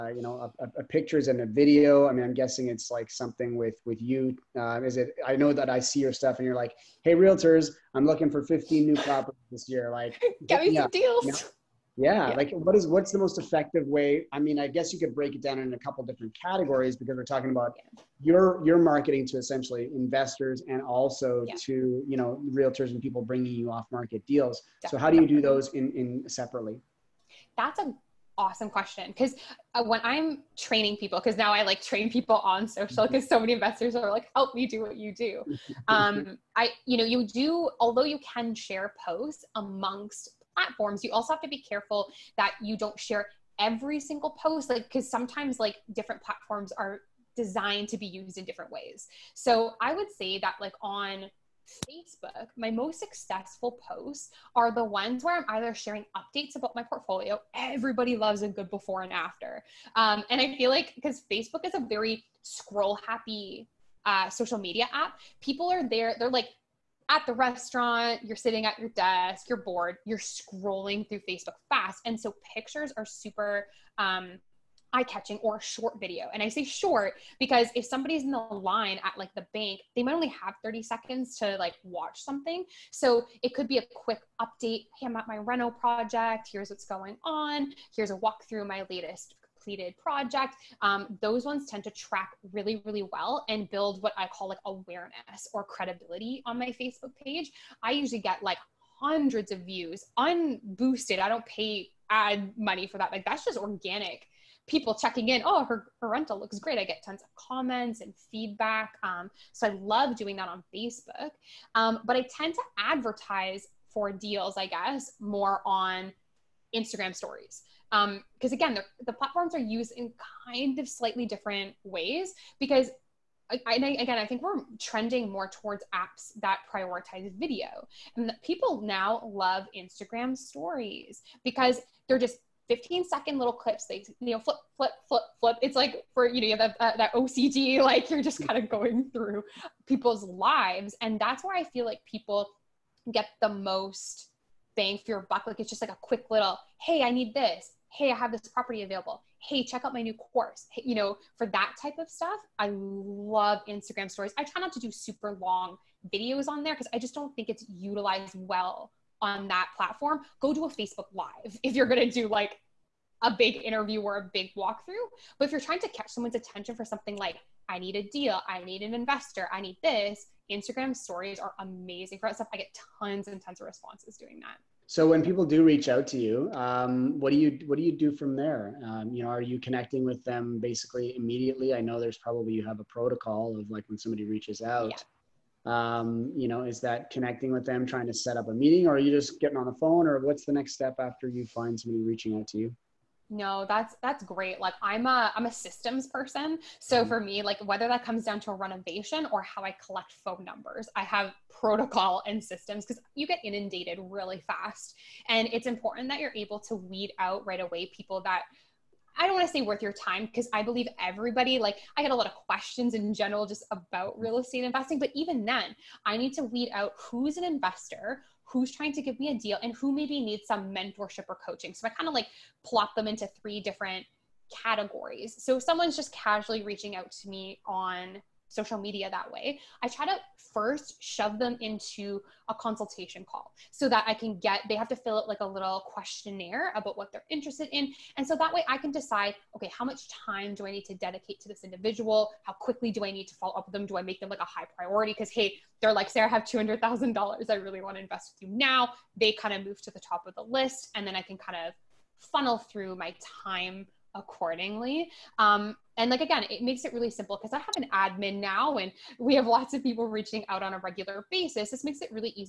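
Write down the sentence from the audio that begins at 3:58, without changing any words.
And so that way I can decide, okay, how much time do I need to dedicate to this individual?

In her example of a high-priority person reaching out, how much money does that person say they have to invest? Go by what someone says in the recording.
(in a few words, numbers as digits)
$200,000.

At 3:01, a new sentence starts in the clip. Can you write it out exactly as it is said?
I know there's probably you have a protocol of like when somebody reaches out.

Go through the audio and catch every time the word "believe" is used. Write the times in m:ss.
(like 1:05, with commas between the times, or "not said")
3:30.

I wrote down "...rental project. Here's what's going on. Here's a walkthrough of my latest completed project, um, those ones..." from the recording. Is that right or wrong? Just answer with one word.
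right.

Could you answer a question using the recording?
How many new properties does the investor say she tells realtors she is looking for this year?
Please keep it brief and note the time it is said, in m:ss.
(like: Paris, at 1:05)
15, at 0:08.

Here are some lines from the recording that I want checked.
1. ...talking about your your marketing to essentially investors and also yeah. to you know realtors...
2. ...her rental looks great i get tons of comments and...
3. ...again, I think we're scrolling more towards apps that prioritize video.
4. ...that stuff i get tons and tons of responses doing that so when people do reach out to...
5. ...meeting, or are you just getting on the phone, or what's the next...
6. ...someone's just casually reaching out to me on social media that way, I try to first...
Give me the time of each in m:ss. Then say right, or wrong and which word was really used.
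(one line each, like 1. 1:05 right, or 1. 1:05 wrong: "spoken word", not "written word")
1. 0:17 right
2. 1:46 right
3. 2:03 wrong: "trending", not "scrolling"
4. 2:52 right
5. 3:08 right
6. 3:45 right.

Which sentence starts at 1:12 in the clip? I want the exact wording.
And so pictures are super um, eye catching or short video.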